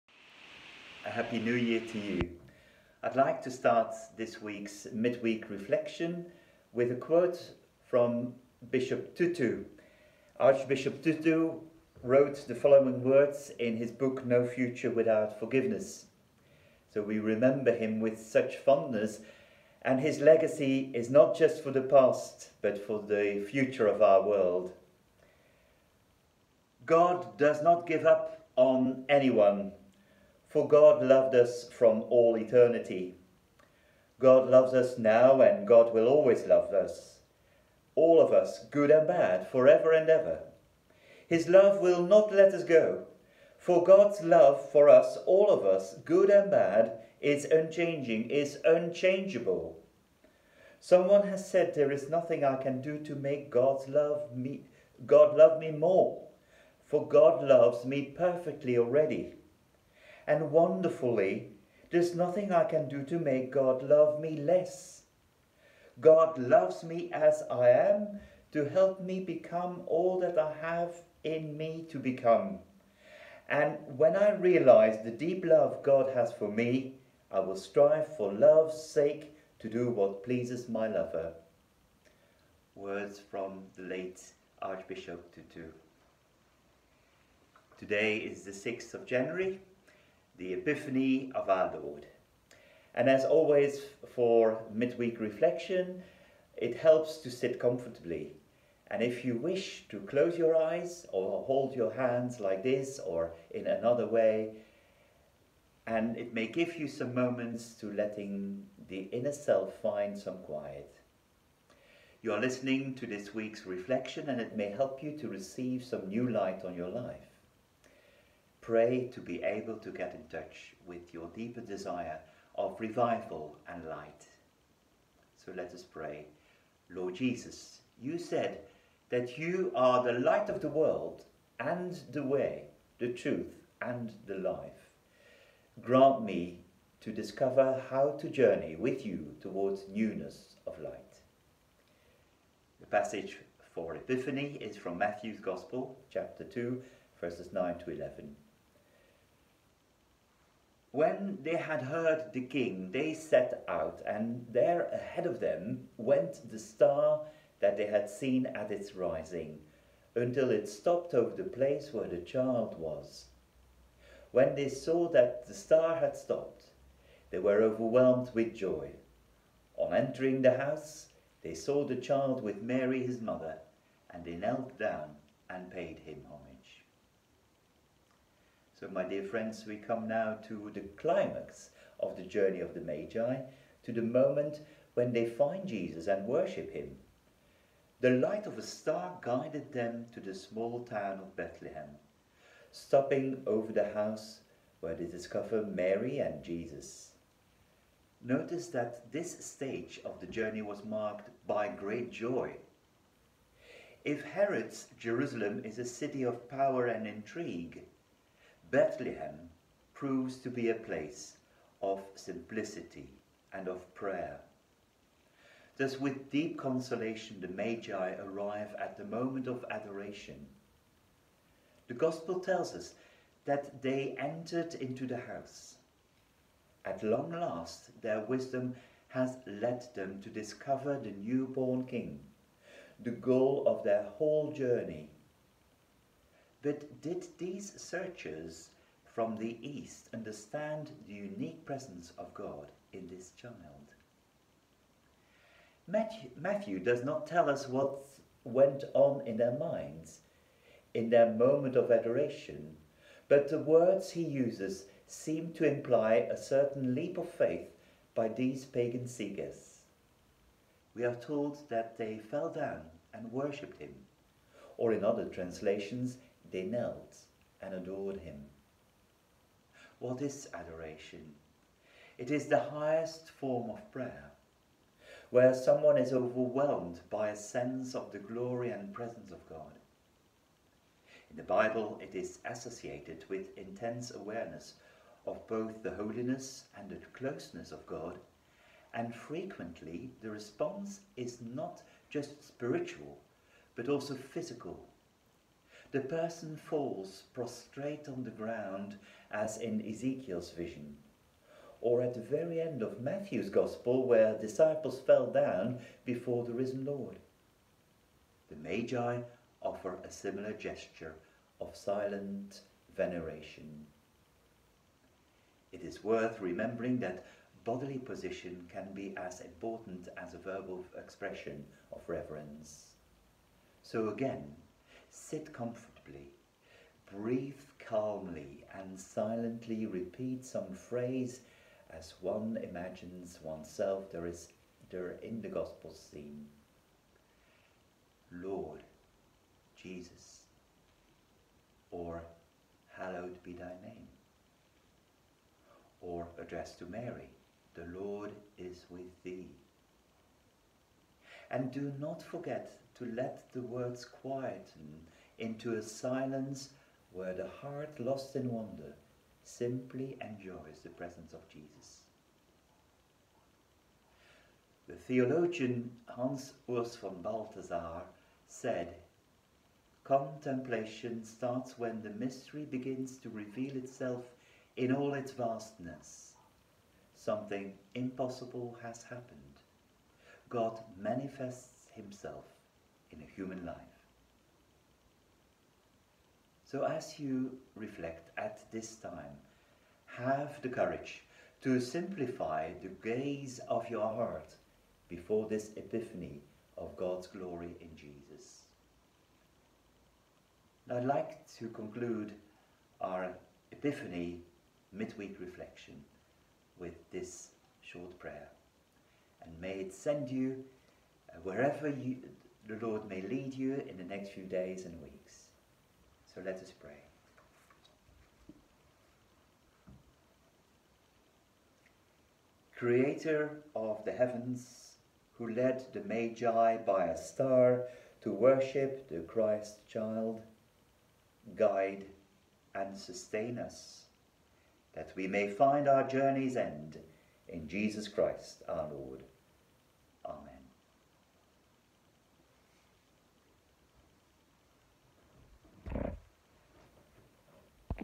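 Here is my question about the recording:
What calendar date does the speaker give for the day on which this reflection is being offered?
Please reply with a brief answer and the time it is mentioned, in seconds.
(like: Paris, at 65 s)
6th of January, at 88 s.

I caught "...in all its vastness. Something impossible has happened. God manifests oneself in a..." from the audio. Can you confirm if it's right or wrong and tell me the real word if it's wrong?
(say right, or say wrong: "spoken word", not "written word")
wrong: "himself", not "oneself".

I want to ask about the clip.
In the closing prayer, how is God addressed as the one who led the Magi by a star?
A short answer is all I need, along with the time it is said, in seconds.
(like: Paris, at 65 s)
Creator of the heavens, at 422 s.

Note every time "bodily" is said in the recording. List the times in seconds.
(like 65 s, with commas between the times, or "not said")
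317 s.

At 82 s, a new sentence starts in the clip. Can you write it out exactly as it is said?
Words from the late Archbishop Tutu.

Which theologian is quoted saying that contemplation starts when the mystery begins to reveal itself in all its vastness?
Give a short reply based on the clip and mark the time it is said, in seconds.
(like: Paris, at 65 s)
Hans Urs von Balthasar, at 366 s.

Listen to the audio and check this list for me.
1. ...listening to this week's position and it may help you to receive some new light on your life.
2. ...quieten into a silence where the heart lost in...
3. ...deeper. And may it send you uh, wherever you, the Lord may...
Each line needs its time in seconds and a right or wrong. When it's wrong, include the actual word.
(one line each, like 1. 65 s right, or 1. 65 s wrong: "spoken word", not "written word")
1. 112 s wrong: "reflection", not "position"
2. 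354 s right
3. 408 s wrong: "prayer", not "deeper".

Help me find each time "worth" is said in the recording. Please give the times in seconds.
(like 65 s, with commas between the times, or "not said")
316 s.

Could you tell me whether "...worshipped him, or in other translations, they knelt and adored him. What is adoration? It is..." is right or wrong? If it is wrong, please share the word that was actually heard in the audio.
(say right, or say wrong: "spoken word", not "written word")
right.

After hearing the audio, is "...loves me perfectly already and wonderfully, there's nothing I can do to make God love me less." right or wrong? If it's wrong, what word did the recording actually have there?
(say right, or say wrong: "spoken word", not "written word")
right.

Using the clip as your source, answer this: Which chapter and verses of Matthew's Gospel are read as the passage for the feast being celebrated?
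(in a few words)
Chapter 2, verses 9 to 11.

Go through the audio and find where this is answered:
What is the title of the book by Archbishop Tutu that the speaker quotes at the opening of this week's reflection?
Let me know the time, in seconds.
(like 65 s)
14 s.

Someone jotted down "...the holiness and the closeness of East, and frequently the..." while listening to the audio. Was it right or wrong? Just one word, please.
wrong.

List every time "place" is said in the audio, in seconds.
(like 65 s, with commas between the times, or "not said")
161 s, 210 s.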